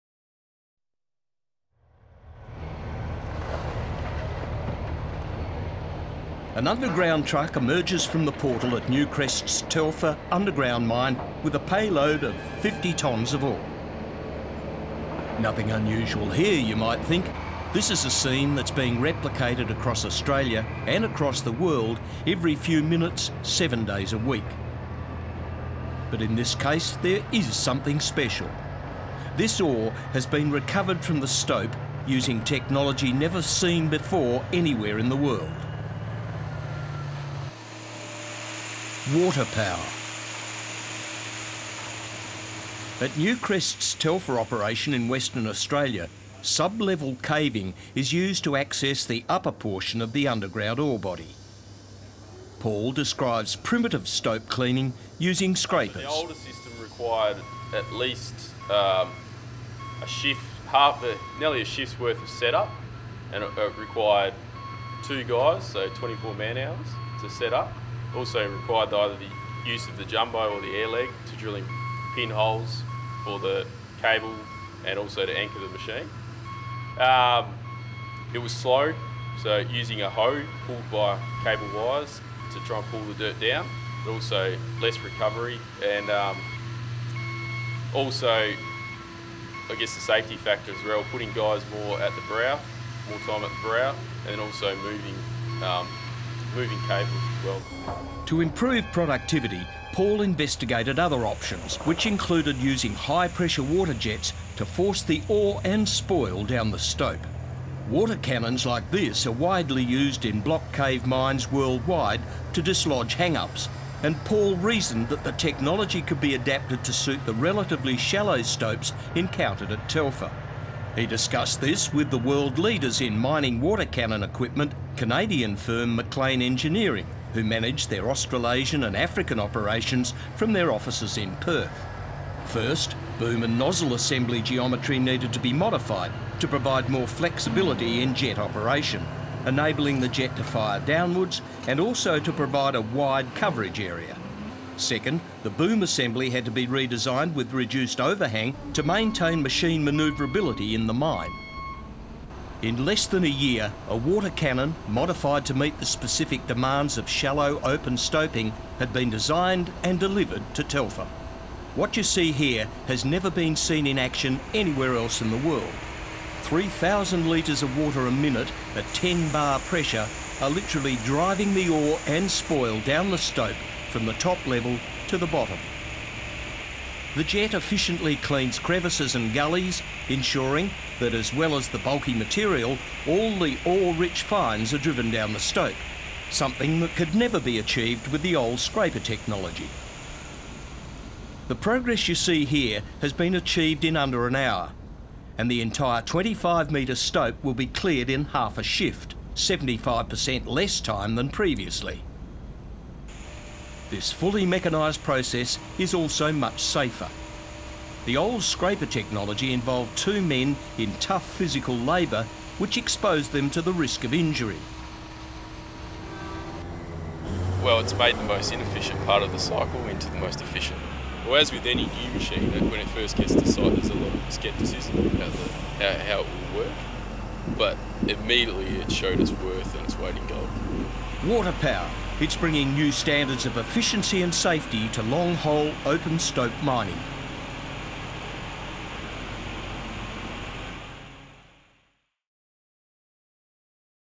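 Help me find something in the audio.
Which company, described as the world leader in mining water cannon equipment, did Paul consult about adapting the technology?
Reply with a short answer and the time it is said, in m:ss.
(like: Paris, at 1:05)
MacLean Engineering, at 2:05.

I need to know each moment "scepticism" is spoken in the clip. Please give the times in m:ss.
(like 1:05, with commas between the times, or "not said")
3:44.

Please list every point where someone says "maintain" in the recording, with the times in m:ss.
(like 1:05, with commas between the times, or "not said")
2:28.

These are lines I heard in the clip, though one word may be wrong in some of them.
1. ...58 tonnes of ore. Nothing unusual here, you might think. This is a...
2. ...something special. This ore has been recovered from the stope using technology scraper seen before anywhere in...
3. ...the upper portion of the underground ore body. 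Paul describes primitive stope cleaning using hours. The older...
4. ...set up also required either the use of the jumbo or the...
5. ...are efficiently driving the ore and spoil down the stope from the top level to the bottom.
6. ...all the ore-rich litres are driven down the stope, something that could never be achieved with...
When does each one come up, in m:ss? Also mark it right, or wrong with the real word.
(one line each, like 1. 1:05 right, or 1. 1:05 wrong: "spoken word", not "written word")
1. 0:12 wrong: "50", not "58"
2. 0:27 wrong: "never", not "scraper"
3. 0:49 wrong: "scrapers", not "hours"
4. 1:07 right
5. 2:50 wrong: "literally", not "efficiently"
6. 3:03 wrong: "fines", not "litres".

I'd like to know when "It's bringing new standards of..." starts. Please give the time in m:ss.
3:52.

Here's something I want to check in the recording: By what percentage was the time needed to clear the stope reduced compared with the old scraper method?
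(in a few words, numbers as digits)
75%.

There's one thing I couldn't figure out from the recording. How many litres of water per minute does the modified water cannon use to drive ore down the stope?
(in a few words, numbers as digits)
3,000 litres.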